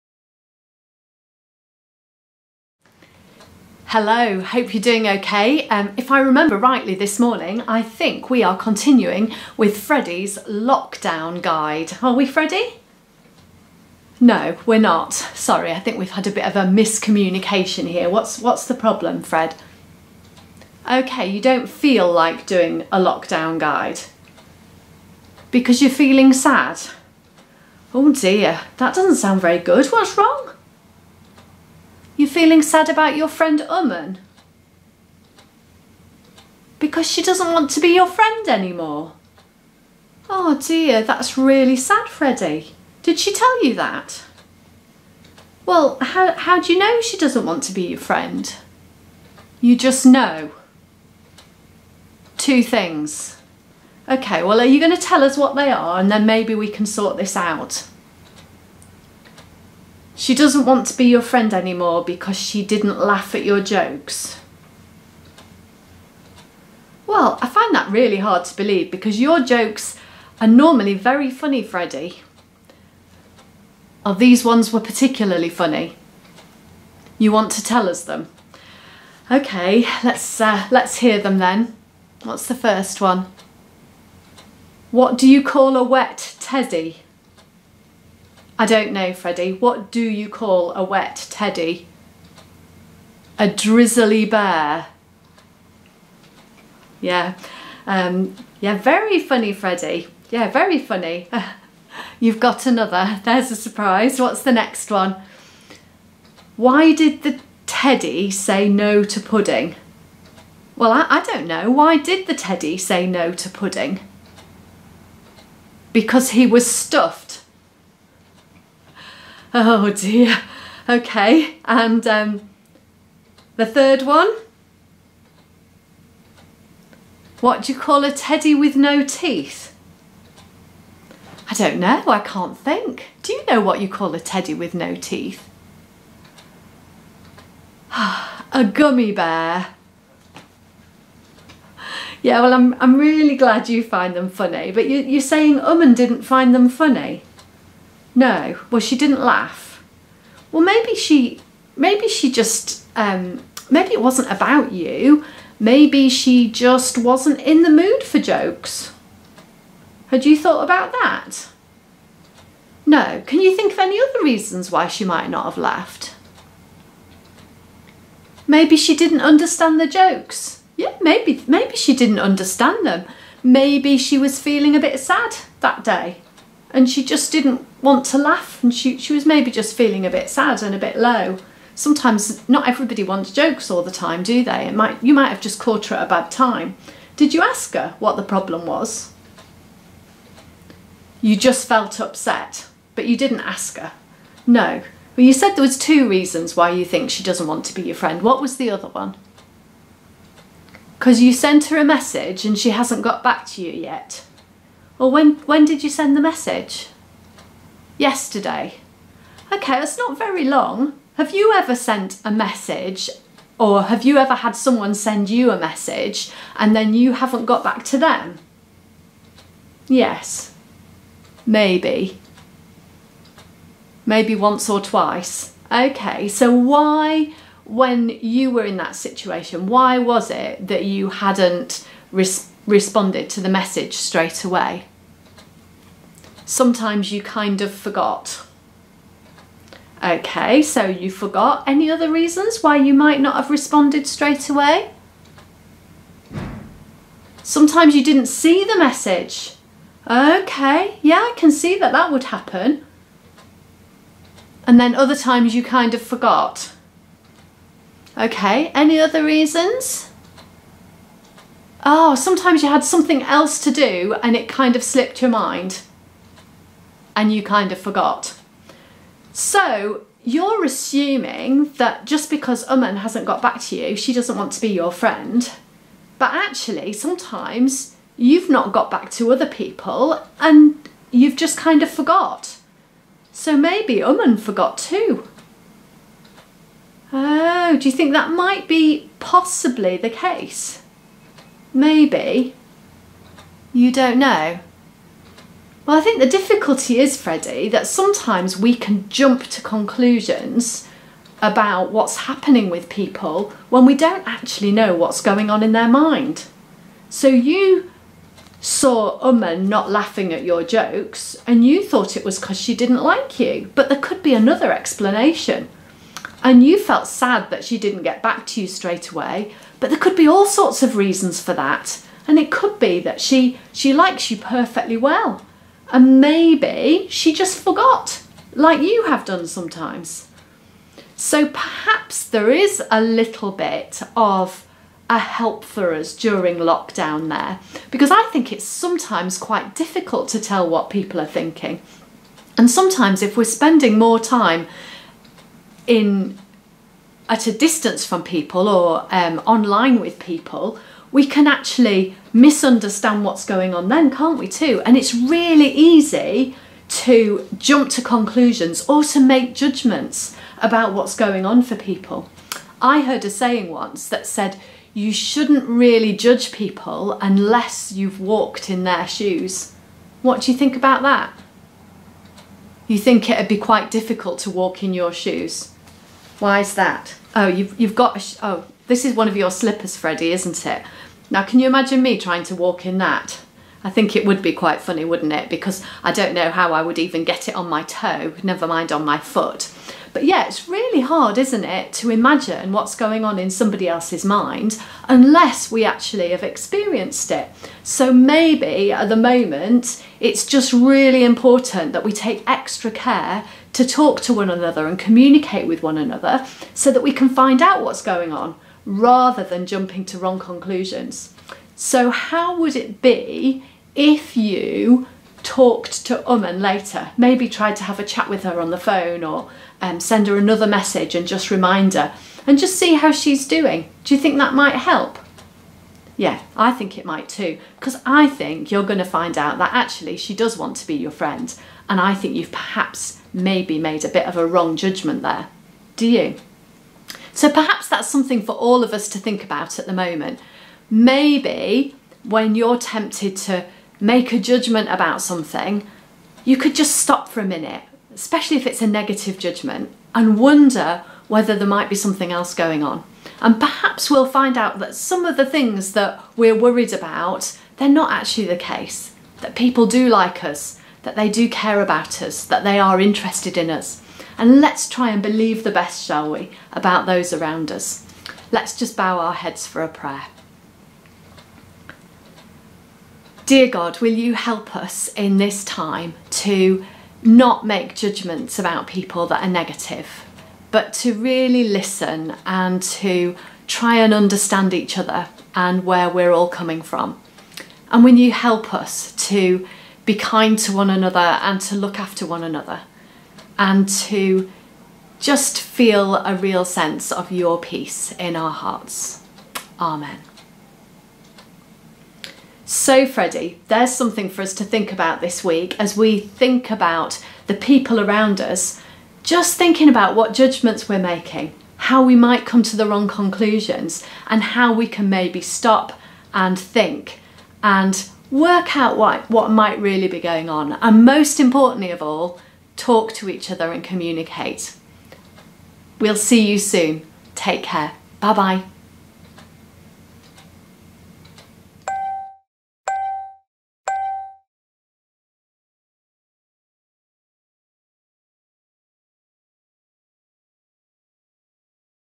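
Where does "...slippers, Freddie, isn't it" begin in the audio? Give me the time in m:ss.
6:19.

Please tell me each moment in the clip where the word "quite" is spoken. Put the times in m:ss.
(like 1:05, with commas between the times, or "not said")
5:39, 6:13, 6:24.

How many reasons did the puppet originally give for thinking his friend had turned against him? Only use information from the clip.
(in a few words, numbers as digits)
2.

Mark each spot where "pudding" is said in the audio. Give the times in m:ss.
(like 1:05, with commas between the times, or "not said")
1:49, 1:53.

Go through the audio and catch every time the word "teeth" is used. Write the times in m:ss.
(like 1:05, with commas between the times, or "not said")
2:09, 2:14.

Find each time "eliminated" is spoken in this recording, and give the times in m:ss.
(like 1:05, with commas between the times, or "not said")
not said.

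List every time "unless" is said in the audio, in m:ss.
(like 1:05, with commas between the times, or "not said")
6:07, 6:35.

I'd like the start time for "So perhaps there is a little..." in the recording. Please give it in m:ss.
5:31.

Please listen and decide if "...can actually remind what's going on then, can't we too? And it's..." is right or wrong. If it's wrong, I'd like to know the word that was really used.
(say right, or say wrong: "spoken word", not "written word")
wrong: "misunderstand", not "remind".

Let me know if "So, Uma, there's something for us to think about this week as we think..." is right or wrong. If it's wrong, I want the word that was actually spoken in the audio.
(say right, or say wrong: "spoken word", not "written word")
wrong: "Freddie", not "Uma".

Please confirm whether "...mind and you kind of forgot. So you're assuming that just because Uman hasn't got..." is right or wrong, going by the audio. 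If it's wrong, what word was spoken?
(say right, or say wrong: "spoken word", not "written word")
right.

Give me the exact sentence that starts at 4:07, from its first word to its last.
Sometimes you didn't see the message.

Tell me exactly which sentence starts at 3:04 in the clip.
It might you might have just caught her at a bad time.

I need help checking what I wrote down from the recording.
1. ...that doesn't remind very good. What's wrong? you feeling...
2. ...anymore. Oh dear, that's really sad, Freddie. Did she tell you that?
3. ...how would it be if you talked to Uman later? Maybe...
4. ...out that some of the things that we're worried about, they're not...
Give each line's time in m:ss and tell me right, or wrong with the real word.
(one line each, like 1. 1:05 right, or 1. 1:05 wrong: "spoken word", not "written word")
1. 0:28 wrong: "sound", not "remind"
2. 0:38 right
3. 6:52 right
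4. 7:34 right.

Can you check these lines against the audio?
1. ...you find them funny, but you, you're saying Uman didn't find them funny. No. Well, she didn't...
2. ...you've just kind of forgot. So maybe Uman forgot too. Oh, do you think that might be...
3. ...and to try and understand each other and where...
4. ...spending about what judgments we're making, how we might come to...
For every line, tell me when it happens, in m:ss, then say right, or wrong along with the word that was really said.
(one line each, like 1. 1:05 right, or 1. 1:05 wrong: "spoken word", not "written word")
1. 2:23 right
2. 4:41 right
3. 8:02 right
4. 8:29 wrong: "thinking", not "spending".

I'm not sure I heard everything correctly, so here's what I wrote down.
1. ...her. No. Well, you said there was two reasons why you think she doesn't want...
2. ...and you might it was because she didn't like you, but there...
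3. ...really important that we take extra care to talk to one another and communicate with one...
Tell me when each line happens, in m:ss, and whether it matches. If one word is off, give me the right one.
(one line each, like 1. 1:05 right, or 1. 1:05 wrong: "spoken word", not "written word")
1. 3:13 right
2. 5:11 wrong: "thought", not "might"
3. 6:40 right.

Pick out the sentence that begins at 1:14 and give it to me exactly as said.
Oh, these ones were particularly funny.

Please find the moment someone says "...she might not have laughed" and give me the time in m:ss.
2:44.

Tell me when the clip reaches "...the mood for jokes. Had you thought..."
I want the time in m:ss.
2:37.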